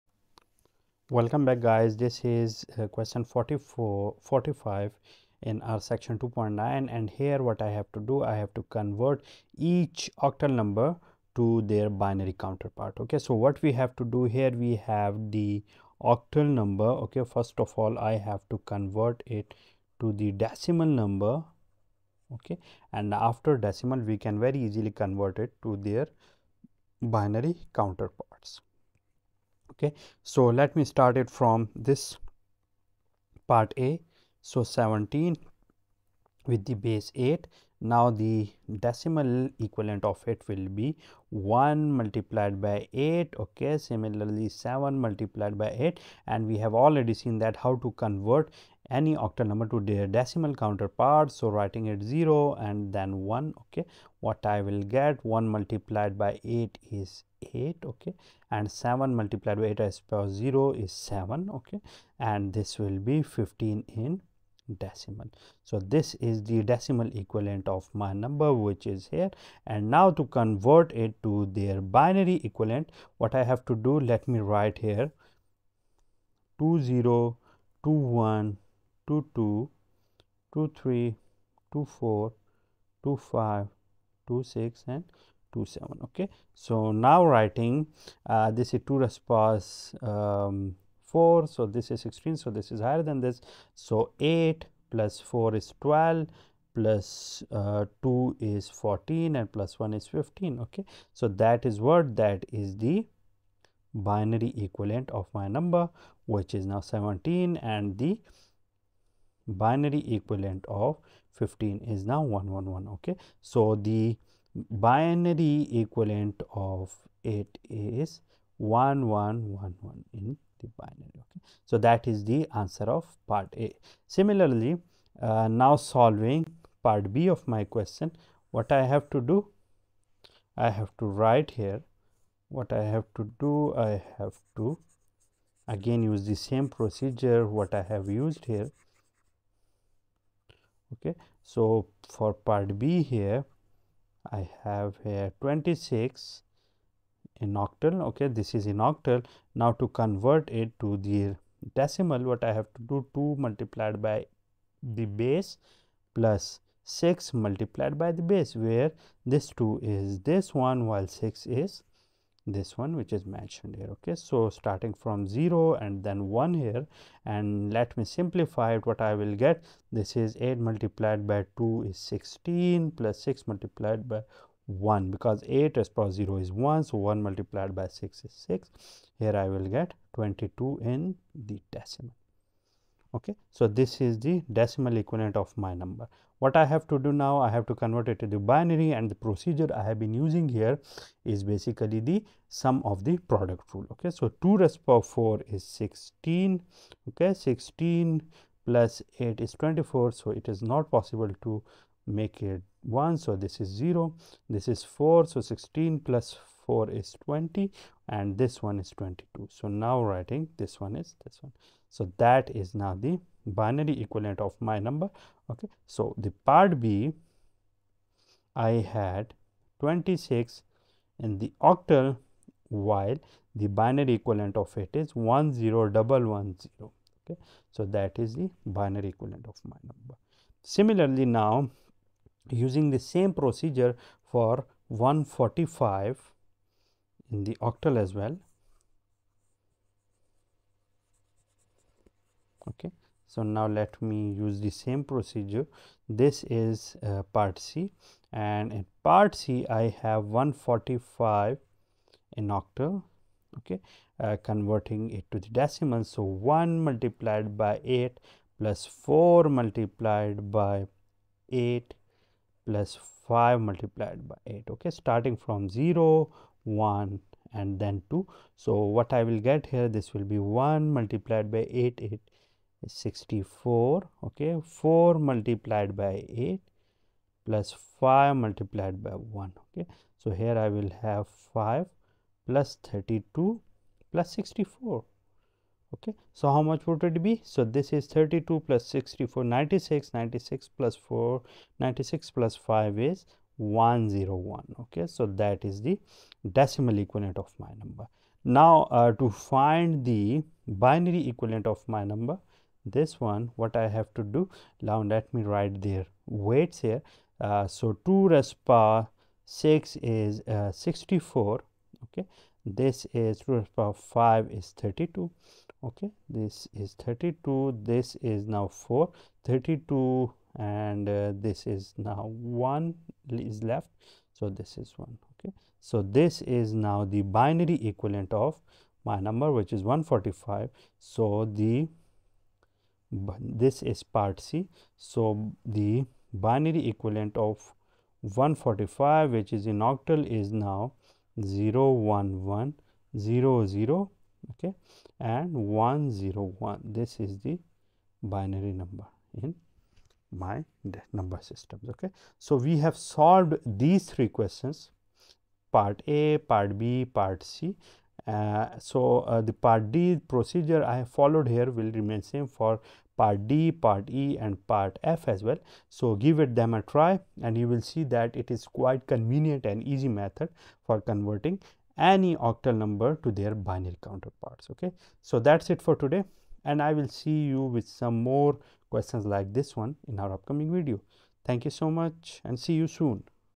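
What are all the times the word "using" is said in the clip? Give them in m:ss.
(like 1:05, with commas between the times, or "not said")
3:10, 3:52.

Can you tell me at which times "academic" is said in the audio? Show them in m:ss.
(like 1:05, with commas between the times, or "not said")
not said.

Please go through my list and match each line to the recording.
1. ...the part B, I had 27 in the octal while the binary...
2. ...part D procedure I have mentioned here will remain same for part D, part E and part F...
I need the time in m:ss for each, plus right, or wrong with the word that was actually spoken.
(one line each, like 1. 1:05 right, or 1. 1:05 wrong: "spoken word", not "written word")
1. 3:36 wrong: "26", not "27"
2. 5:59 wrong: "followed", not "mentioned".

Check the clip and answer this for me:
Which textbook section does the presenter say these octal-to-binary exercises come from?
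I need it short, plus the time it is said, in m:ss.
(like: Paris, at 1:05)
2.9, at 0:05.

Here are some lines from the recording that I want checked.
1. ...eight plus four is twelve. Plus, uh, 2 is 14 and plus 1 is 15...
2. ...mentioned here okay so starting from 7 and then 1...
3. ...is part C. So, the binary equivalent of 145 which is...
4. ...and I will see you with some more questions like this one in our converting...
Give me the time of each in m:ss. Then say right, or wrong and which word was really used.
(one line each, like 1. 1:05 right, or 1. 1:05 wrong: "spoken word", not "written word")
1. 1:34 right
2. 2:43 wrong: "0", not "7"
3. 5:33 right
4. 6:16 wrong: "upcoming", not "converting".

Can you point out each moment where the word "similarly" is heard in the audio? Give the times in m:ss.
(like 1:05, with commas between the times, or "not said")
0:43, 2:04, 3:50.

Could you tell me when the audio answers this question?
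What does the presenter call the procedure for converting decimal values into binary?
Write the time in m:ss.
3:12.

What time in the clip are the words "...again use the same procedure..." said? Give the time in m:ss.
2:15.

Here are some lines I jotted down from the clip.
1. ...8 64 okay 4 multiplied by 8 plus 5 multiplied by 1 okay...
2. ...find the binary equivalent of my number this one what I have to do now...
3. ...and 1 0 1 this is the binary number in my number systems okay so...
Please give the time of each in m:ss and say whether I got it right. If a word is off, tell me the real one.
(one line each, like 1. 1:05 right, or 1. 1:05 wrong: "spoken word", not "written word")
1. 4:32 right
2. 4:59 right
3. 5:45 right.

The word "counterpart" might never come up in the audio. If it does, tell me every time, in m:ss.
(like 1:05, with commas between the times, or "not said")
0:12, 0:27, 0:50, 6:14.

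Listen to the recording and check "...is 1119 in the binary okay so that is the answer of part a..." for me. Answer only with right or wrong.
wrong.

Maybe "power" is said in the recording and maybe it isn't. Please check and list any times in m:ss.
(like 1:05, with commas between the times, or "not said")
2:55, 3:14, 5:08, 5:13.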